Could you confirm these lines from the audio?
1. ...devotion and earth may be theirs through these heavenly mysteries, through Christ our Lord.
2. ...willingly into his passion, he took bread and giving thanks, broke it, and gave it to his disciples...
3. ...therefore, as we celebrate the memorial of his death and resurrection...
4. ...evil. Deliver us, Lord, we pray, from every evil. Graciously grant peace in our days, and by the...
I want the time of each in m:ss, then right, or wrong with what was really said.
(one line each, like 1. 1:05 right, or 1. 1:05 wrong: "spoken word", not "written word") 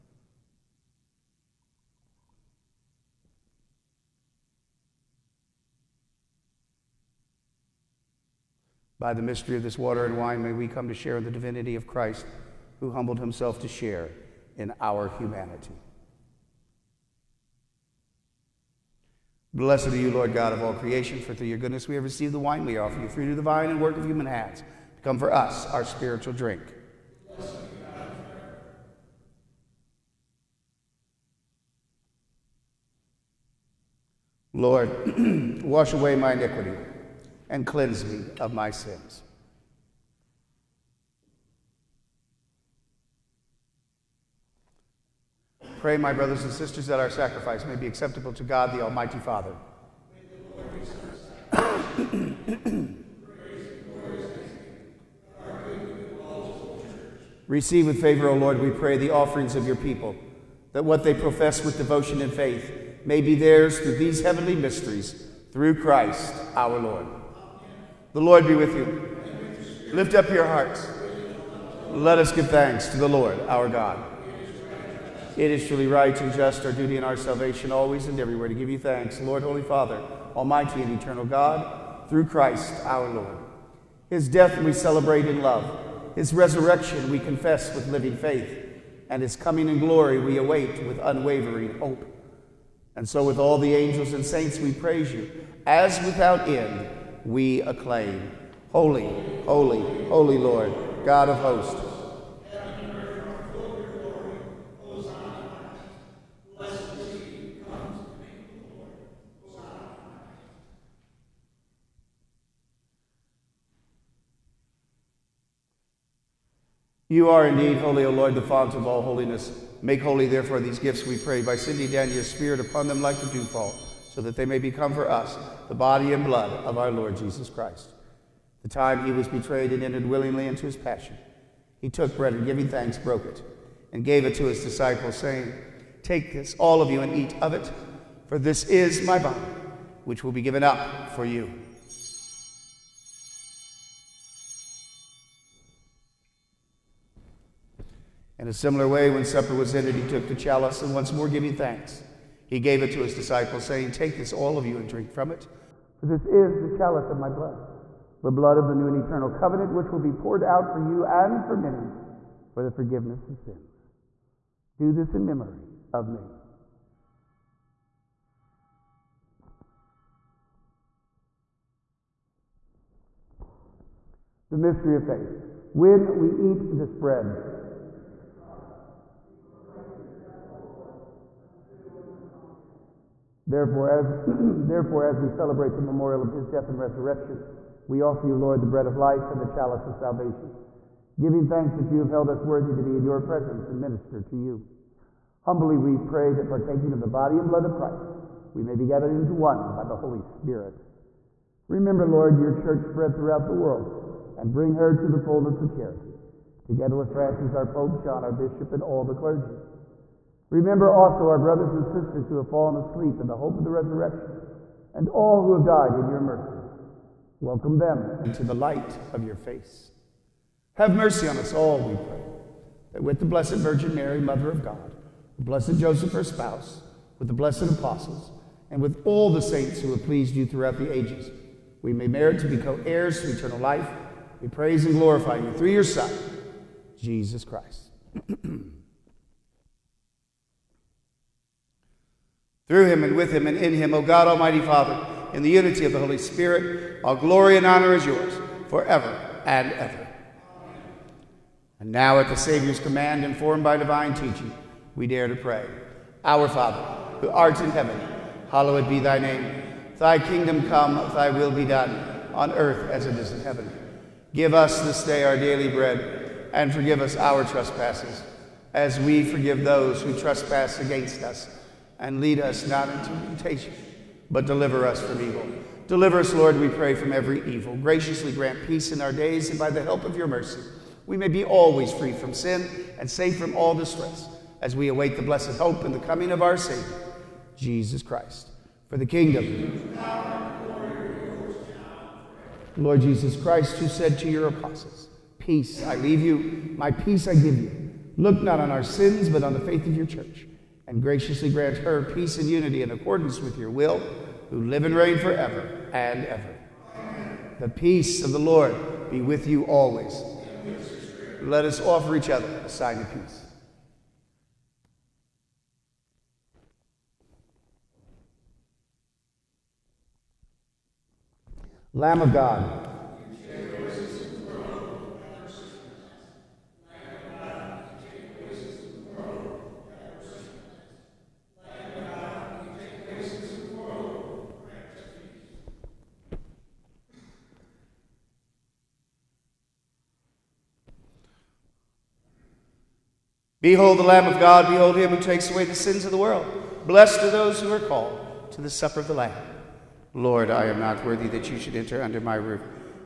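1. 1:01 wrong: "faith", not "earth"
2. 2:10 right
3. 3:04 right
4. 4:35 right.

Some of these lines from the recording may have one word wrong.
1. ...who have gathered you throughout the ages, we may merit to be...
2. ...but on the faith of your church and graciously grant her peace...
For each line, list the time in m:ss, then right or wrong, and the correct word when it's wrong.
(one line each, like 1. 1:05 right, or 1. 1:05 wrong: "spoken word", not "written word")
1. 3:49 wrong: "pleased", not "gathered"
2. 4:59 right.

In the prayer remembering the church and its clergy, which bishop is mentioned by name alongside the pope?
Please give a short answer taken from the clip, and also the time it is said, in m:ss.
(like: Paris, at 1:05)
John, at 3:28.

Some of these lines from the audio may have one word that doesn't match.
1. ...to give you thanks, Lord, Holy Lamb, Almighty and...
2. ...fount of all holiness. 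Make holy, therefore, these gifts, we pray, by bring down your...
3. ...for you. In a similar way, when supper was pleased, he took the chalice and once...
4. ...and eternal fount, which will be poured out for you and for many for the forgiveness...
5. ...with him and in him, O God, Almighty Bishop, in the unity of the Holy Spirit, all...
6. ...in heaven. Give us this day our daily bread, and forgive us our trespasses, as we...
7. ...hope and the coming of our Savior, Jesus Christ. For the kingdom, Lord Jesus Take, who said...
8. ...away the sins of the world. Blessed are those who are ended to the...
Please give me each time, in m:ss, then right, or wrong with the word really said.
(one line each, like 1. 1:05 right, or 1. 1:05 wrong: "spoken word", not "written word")
1. 1:18 wrong: "Father", not "Lamb"
2. 1:58 wrong: "sending", not "bring"
3. 2:21 wrong: "ended", not "pleased"
4. 2:38 wrong: "covenant", not "fount"
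5. 4:03 wrong: "Father", not "Bishop"
6. 4:23 right
7. 4:45 wrong: "Christ", not "Take"
8. 5:45 wrong: "called", not "ended".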